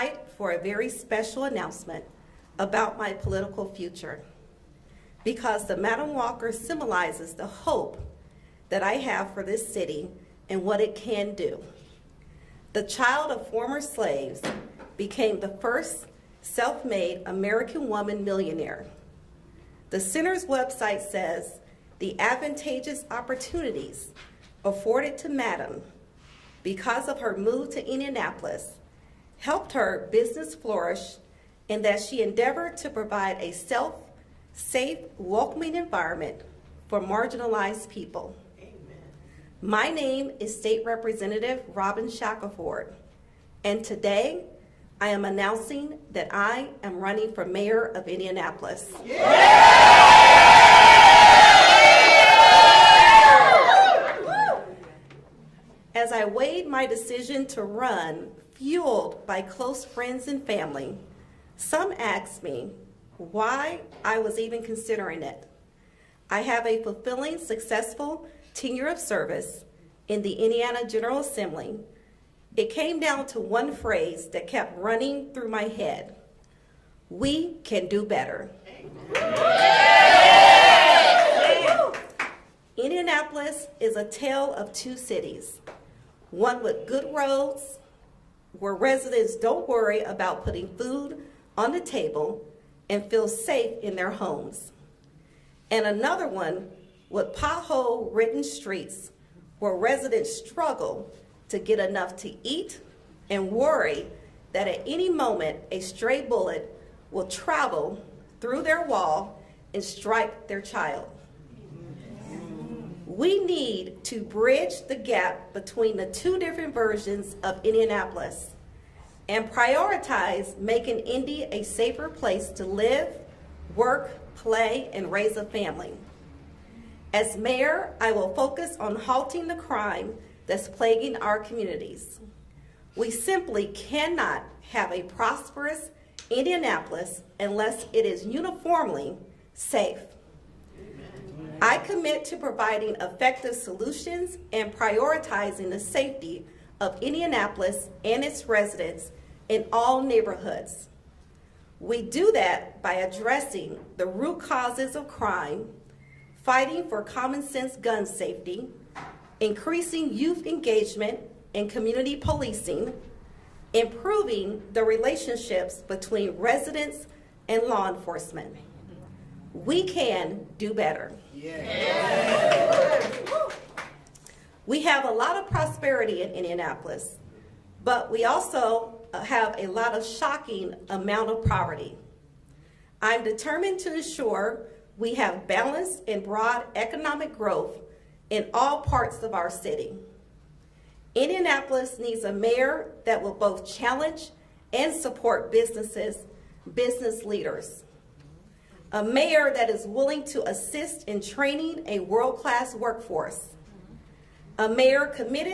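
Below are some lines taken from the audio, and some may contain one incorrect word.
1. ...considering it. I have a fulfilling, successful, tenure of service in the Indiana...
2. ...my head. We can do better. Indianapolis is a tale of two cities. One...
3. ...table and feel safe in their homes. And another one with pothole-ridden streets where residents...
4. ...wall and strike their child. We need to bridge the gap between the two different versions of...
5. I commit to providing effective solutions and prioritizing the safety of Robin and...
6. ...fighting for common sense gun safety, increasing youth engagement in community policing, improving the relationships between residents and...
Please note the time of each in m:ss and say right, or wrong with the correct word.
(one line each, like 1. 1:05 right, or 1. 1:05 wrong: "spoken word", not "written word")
1. 1:04 right
2. 1:15 right
3. 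1:31 right
4. 1:48 right
5. 2:21 wrong: "Indianapolis", not "Robin"
6. 2:36 right.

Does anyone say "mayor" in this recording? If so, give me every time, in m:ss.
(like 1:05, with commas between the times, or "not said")
0:47, 2:07, 3:12, 3:19, 3:24.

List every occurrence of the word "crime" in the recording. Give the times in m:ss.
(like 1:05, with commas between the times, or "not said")
2:09, 2:35.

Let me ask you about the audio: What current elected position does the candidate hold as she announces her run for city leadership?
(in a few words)
State Representative.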